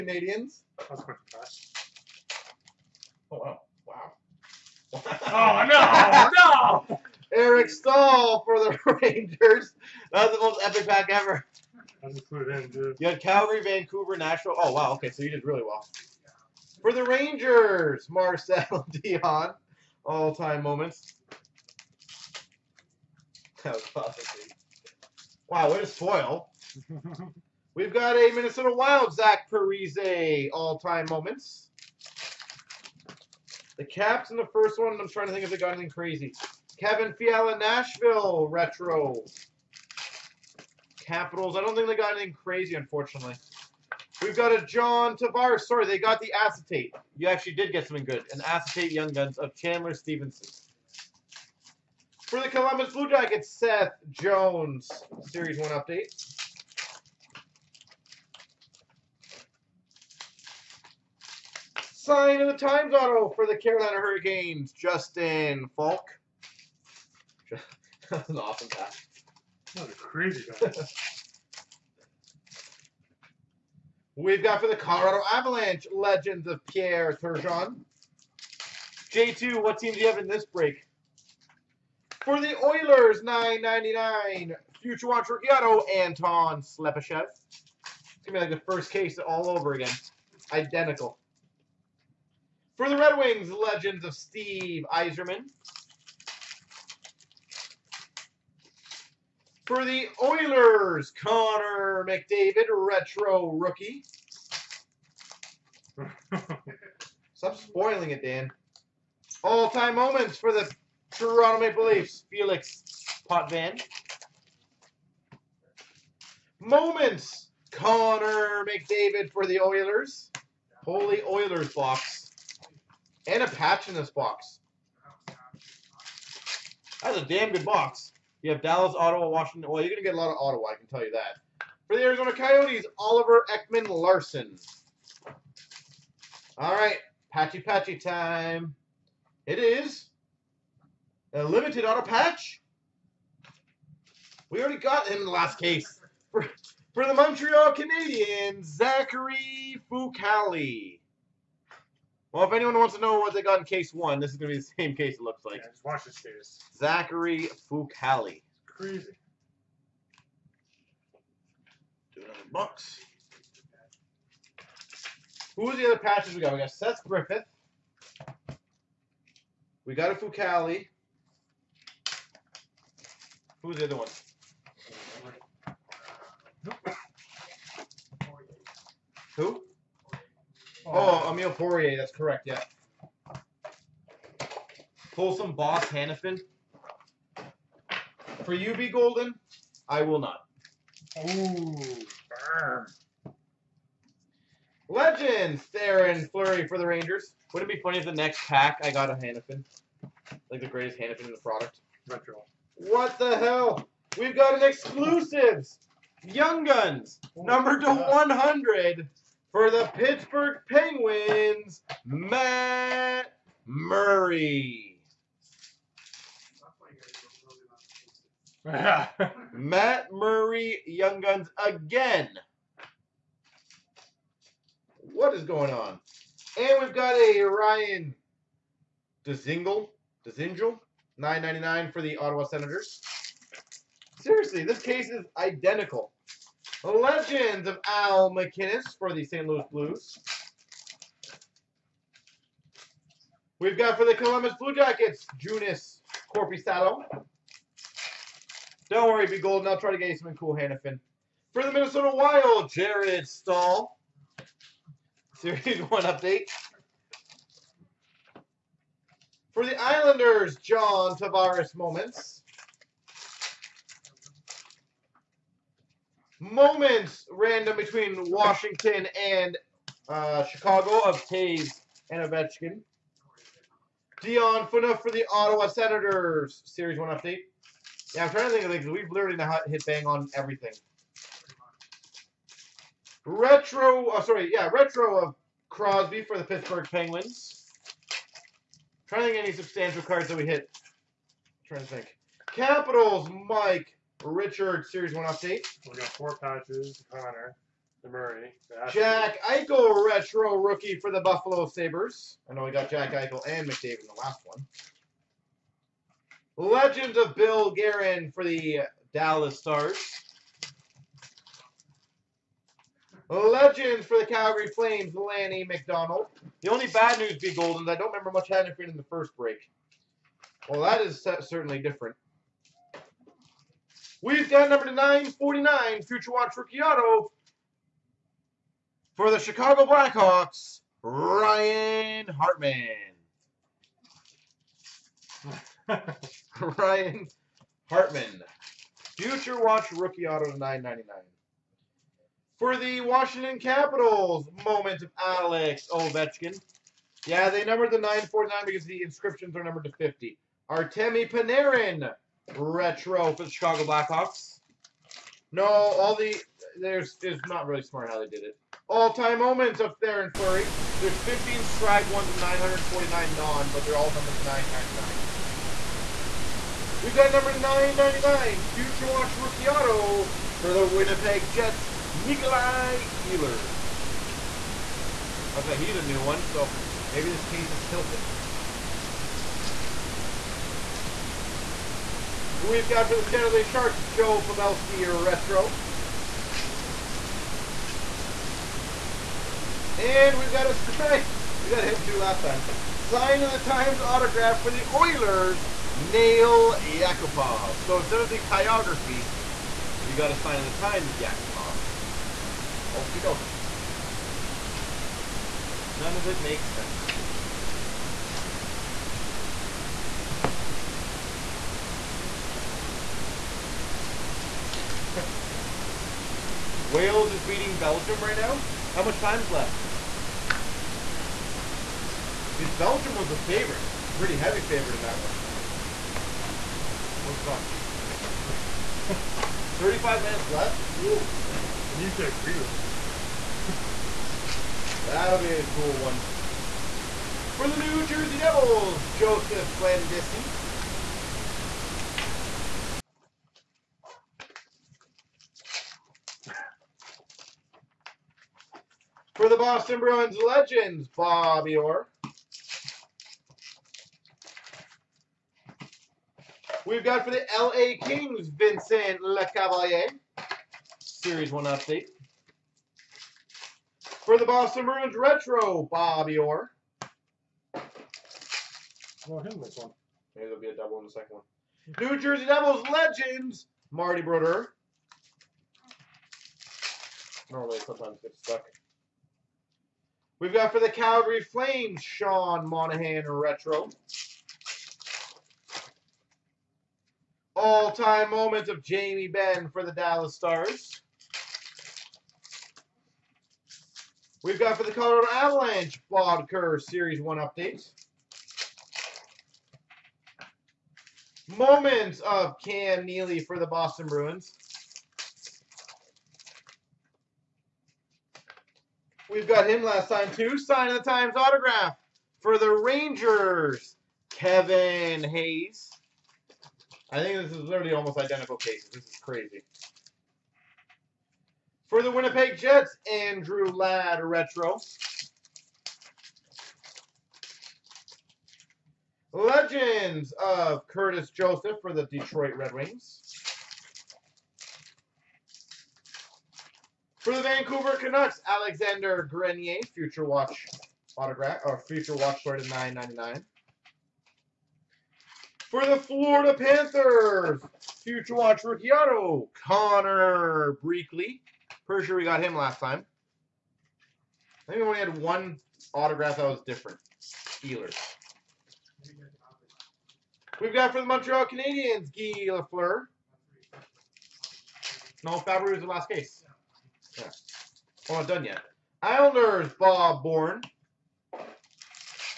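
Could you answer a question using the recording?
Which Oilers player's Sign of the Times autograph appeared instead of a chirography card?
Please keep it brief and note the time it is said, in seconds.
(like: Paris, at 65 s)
Nail Yakupov, at 395 s.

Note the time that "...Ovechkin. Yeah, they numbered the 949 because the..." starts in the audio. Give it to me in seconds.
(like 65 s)
345 s.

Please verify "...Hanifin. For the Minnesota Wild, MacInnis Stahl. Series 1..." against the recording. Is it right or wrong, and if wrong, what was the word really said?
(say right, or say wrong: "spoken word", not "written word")
wrong: "Jared", not "MacInnis".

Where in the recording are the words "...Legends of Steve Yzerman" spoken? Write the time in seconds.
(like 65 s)
93 s.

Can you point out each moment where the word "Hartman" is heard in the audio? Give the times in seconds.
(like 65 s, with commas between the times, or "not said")
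332 s, 337 s.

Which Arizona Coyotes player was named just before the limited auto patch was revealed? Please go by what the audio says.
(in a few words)
Oliver Ekman Larsson.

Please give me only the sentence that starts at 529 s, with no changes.
Legends of Curtis Joseph for the Detroit Red Wings.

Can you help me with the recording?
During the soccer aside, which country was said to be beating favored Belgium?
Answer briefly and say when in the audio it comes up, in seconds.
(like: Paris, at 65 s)
Wales, at 416 s.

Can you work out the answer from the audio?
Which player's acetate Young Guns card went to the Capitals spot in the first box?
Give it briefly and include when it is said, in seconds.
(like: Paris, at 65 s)
Chandler Stephenson, at 49 s.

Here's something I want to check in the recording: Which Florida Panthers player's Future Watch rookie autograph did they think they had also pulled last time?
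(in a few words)
Connor Brickley.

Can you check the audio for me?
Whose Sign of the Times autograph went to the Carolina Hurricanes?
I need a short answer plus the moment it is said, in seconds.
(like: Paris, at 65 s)
Justin Faulk, at 64 s.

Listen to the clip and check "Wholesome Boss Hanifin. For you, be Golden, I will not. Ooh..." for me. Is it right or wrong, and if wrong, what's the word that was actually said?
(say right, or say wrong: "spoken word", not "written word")
right.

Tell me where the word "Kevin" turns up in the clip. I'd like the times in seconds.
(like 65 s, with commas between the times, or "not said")
36 s, 514 s.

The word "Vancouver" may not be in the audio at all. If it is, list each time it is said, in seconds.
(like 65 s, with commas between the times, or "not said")
13 s, 537 s.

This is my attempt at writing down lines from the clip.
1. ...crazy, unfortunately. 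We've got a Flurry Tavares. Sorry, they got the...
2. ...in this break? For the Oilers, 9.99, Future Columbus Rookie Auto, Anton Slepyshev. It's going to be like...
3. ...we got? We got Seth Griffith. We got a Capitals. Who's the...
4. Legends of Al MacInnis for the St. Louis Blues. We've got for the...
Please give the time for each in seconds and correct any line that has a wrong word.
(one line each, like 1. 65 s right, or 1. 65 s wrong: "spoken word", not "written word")
1. 42 s wrong: "John", not "Flurry"
2. 80 s wrong: "Watch", not "Columbus"
3. 166 s wrong: "Fucale", not "Capitals"
4. 236 s right.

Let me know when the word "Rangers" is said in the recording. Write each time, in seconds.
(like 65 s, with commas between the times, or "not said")
9 s, 17 s, 196 s, 512 s.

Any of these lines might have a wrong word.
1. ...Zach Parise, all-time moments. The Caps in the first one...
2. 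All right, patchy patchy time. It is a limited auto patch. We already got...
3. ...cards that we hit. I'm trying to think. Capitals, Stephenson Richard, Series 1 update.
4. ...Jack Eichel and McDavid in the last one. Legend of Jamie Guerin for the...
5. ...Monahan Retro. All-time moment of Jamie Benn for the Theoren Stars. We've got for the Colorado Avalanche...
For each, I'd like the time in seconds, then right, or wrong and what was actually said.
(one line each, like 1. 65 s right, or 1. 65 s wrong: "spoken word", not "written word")
1. 29 s right
2. 136 s right
3. 290 s wrong: "Mike", not "Stephenson"
4. 302 s wrong: "Bill", not "Jamie"
5. 482 s wrong: "Dallas", not "Theoren".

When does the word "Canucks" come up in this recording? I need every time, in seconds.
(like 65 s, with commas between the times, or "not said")
537 s.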